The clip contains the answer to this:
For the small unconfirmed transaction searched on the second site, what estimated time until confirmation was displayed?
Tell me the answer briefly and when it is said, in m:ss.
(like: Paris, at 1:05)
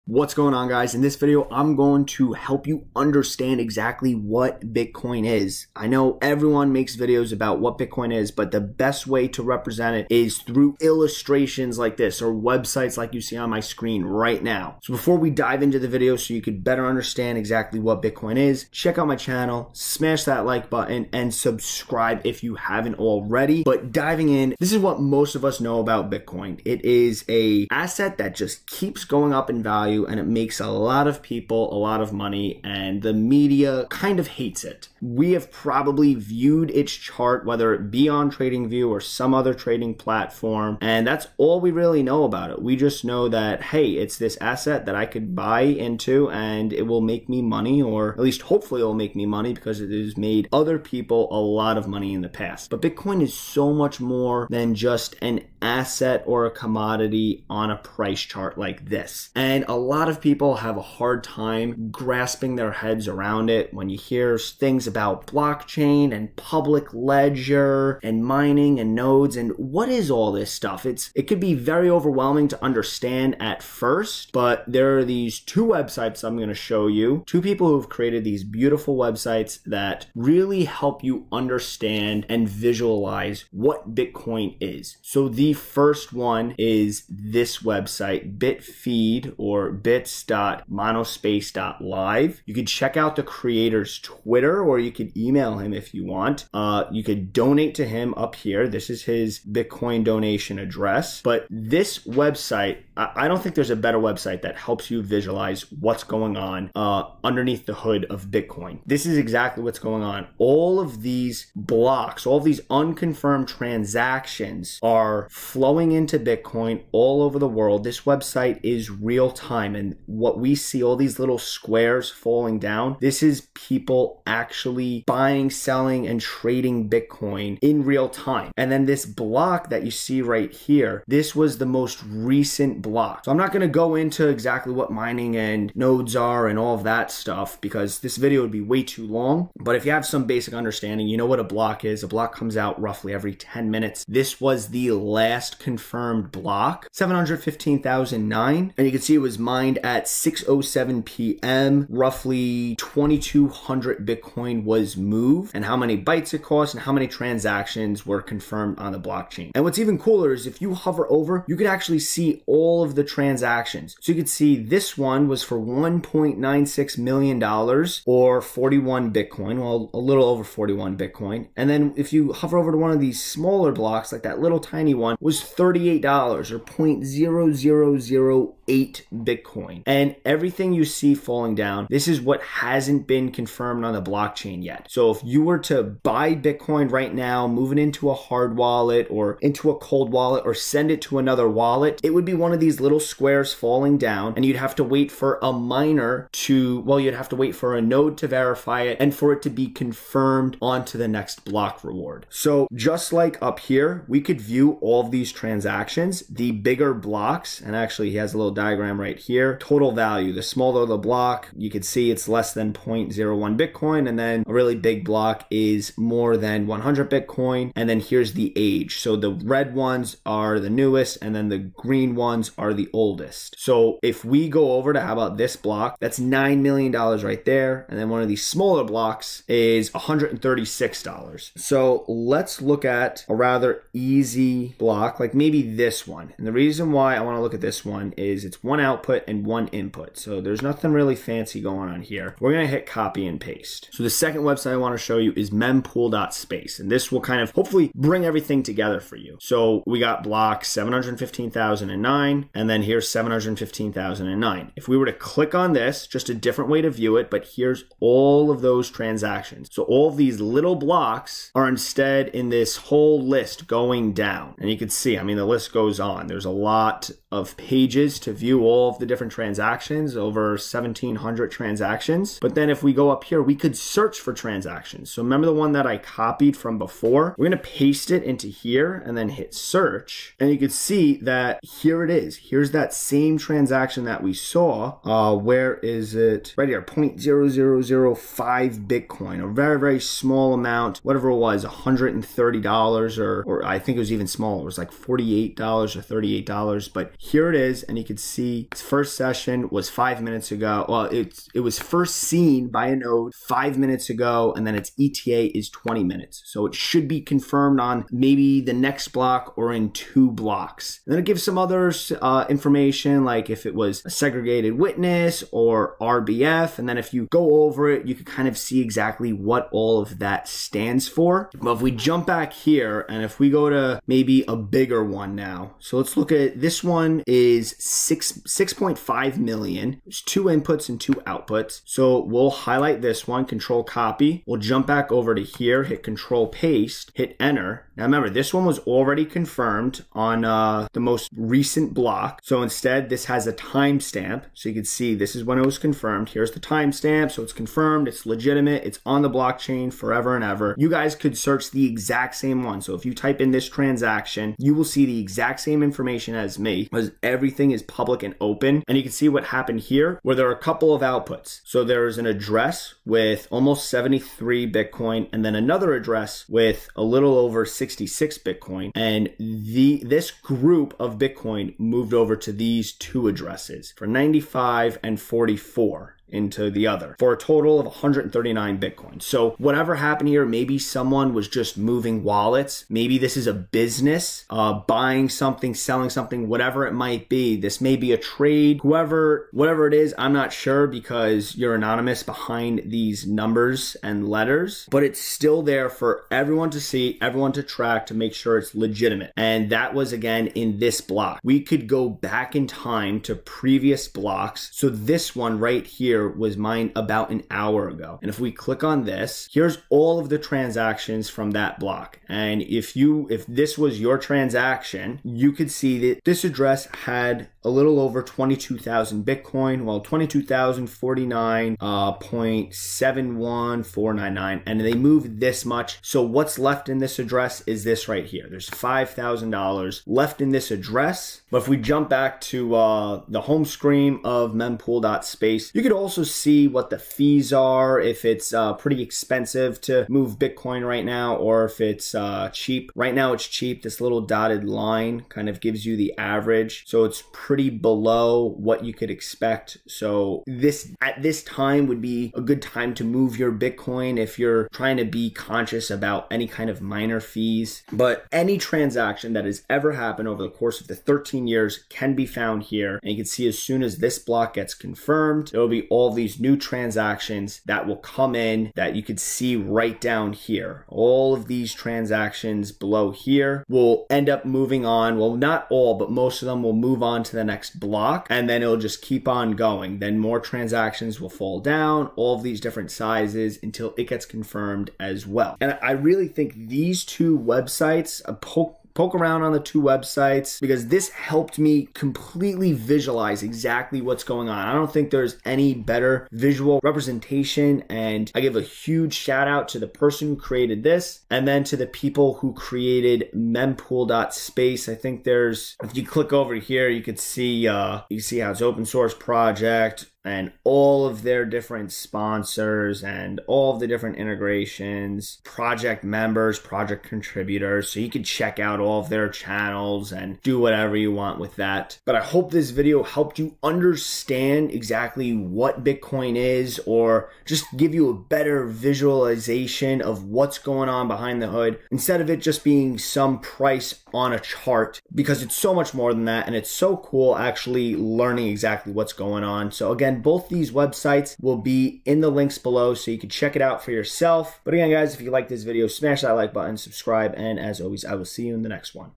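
20 minutes, at 5:05.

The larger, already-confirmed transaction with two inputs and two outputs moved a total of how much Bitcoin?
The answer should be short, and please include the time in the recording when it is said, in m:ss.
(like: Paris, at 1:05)
139 Bitcoin, at 6:17.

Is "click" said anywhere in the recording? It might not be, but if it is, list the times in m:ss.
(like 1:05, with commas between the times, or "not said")
4:15, 6:48, 8:26.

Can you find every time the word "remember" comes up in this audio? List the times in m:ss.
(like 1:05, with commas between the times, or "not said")
4:35, 5:38.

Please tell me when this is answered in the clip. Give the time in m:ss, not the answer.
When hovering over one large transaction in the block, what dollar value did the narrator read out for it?
2:45.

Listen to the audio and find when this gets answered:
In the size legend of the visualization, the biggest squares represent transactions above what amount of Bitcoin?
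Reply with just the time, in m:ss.
3:35.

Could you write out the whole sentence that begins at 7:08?
There's $5,000 left in this address.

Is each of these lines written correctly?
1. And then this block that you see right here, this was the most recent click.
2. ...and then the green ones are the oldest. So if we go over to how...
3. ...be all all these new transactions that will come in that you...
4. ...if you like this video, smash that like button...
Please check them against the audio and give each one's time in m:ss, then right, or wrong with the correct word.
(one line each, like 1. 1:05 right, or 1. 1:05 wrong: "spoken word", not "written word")
1. 2:08 wrong: "block", not "click"
2. 3:41 right
3. 7:45 right
4. 9:05 right.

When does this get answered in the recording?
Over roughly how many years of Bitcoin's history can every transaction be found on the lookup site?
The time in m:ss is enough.
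7:40.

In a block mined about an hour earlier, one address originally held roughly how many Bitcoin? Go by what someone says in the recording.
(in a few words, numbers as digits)
22,000 Bitcoin.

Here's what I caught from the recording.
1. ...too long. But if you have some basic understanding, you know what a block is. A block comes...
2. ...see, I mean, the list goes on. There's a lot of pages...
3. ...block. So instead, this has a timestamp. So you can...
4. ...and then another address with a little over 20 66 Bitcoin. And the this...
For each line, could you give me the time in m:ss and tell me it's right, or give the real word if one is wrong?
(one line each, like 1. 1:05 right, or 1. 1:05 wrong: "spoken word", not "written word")
1. 2:18 right
2. 4:24 right
3. 5:41 right
4. 6:05 wrong: "60", not "20".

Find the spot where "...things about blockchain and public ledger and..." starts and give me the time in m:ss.
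1:04.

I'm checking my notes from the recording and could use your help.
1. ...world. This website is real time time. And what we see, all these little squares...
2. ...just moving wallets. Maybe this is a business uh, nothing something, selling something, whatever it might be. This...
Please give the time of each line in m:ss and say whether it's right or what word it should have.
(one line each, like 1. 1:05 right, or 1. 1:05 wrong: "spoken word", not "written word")
1. 1:57 right
2. 6:21 wrong: "buying", not "nothing".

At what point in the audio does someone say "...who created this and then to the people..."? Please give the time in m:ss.
8:20.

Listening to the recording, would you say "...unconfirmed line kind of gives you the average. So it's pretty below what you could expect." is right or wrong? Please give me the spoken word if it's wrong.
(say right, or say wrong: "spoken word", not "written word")
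wrong: "dotted", not "unconfirmed".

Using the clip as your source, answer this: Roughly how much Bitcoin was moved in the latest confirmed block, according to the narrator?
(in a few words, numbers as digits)
2,200 Bitcoin.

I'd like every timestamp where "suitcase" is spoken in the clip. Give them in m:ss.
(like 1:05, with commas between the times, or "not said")
not said.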